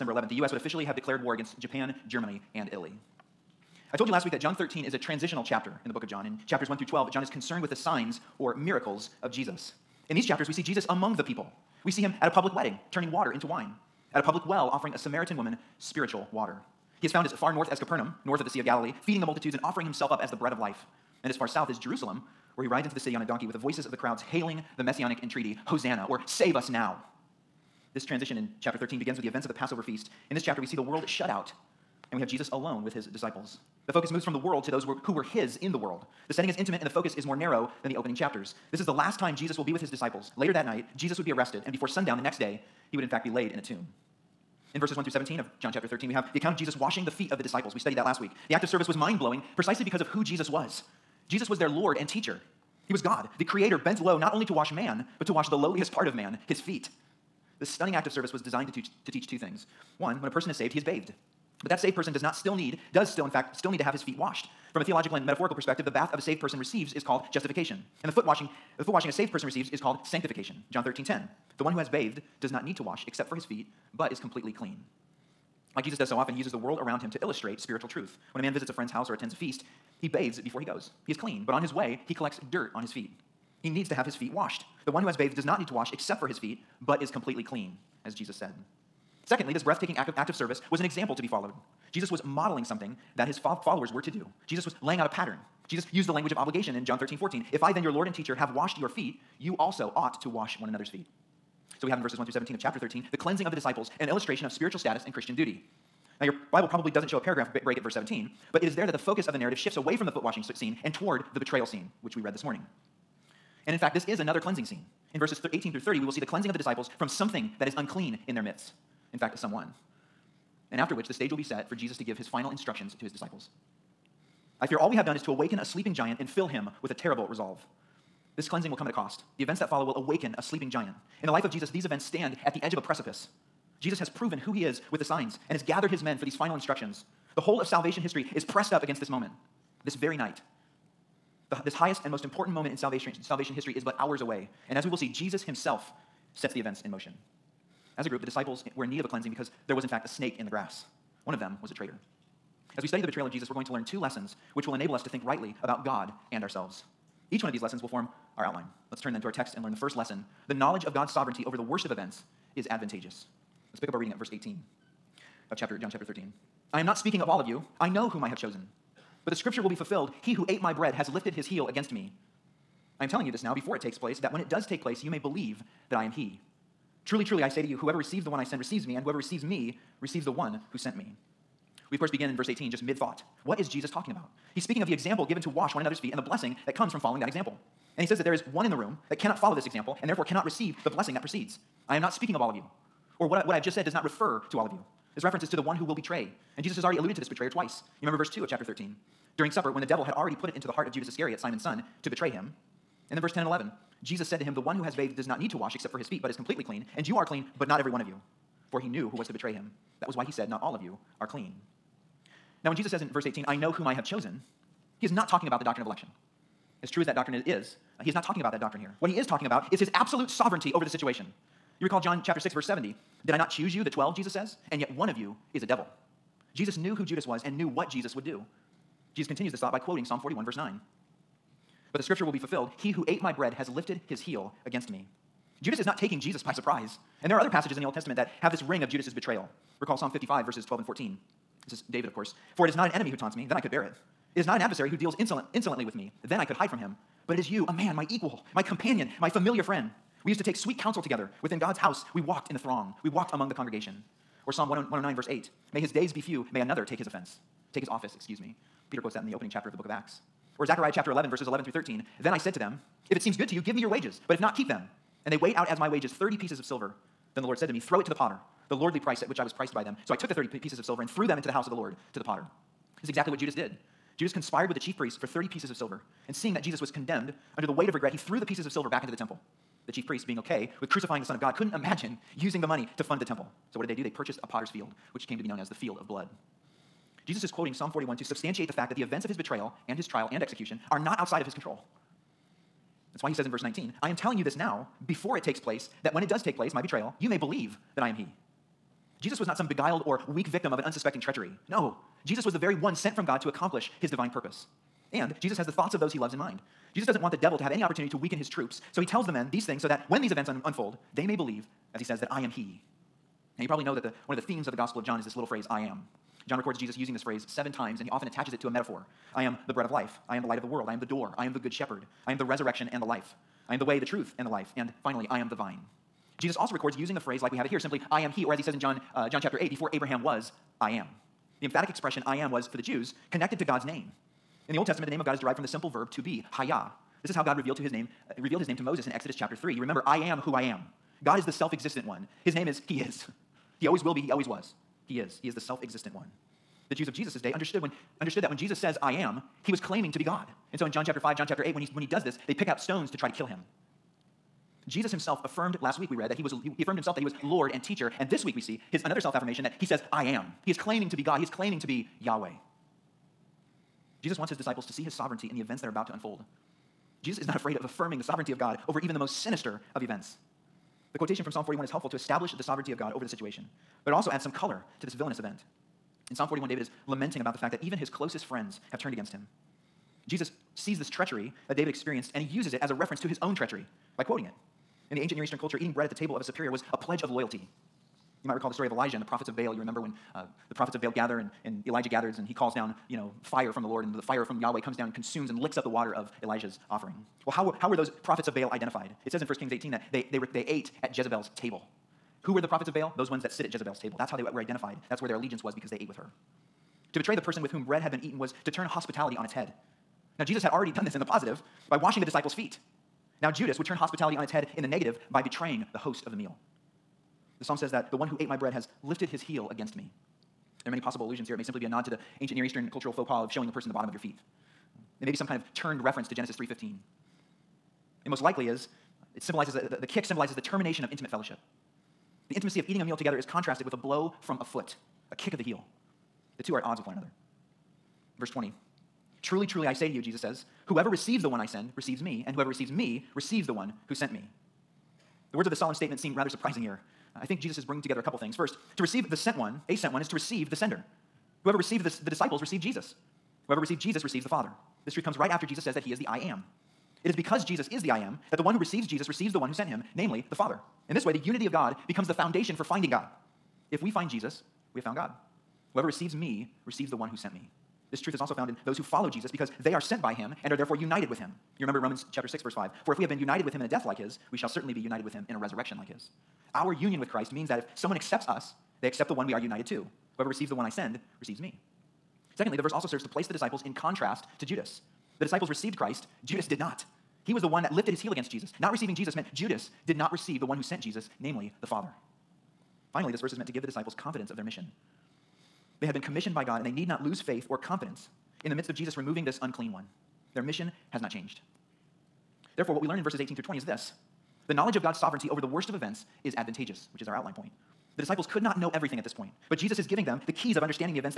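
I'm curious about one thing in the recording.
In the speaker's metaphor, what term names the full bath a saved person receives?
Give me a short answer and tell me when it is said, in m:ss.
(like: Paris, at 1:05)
Justification, at 1:07.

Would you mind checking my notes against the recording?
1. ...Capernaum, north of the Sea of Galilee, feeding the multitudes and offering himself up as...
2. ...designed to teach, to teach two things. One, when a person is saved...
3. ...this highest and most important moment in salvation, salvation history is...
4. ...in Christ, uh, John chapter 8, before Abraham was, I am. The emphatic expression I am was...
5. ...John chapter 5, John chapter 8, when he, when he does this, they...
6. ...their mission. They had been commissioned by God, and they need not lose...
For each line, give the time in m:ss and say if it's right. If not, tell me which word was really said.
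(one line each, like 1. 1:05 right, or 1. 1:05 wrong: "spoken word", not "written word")
1. 0:17 right
2. 0:58 right
3. 2:21 right
4. 5:28 wrong: "John", not "Christ"
5. 5:50 right
6. 8:14 right.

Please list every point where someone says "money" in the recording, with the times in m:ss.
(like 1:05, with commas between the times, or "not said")
4:42.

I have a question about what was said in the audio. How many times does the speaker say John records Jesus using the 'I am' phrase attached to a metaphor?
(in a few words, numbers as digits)
7.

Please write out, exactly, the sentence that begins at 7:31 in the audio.
Whoever received this, the disciples received Jesus.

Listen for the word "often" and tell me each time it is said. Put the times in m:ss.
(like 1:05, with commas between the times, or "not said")
1:16, 5:18.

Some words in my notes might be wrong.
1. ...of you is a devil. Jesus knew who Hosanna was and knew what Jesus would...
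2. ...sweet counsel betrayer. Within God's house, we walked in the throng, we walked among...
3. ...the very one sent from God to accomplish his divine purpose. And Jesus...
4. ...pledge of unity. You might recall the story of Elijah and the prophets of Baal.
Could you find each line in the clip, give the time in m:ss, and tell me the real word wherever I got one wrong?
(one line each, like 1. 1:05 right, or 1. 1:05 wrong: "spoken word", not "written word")
1. 3:45 wrong: "Judas", not "Hosanna"
2. 4:10 wrong: "together", not "betrayer"
3. 5:02 right
4. 6:26 wrong: "loyalty", not "unity".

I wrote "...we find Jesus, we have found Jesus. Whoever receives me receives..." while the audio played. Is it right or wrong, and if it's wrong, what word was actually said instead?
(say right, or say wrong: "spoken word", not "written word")
wrong: "God", not "Jesus".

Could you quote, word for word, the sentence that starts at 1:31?
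Jesus was modeling something that his fo- followers were to do.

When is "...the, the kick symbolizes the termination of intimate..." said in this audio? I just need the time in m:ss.
7:09.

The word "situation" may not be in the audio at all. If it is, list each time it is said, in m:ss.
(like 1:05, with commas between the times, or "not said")
3:40, 6:13.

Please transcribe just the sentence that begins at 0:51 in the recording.
Jesus was their Lord and teacher.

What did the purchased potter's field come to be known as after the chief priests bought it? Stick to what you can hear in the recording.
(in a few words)
The field of blood.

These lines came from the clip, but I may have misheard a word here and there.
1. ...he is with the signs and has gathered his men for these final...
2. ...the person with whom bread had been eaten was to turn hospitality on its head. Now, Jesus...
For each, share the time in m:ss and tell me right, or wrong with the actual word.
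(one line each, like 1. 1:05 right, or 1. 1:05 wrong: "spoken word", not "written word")
1. 2:14 right
2. 6:47 right.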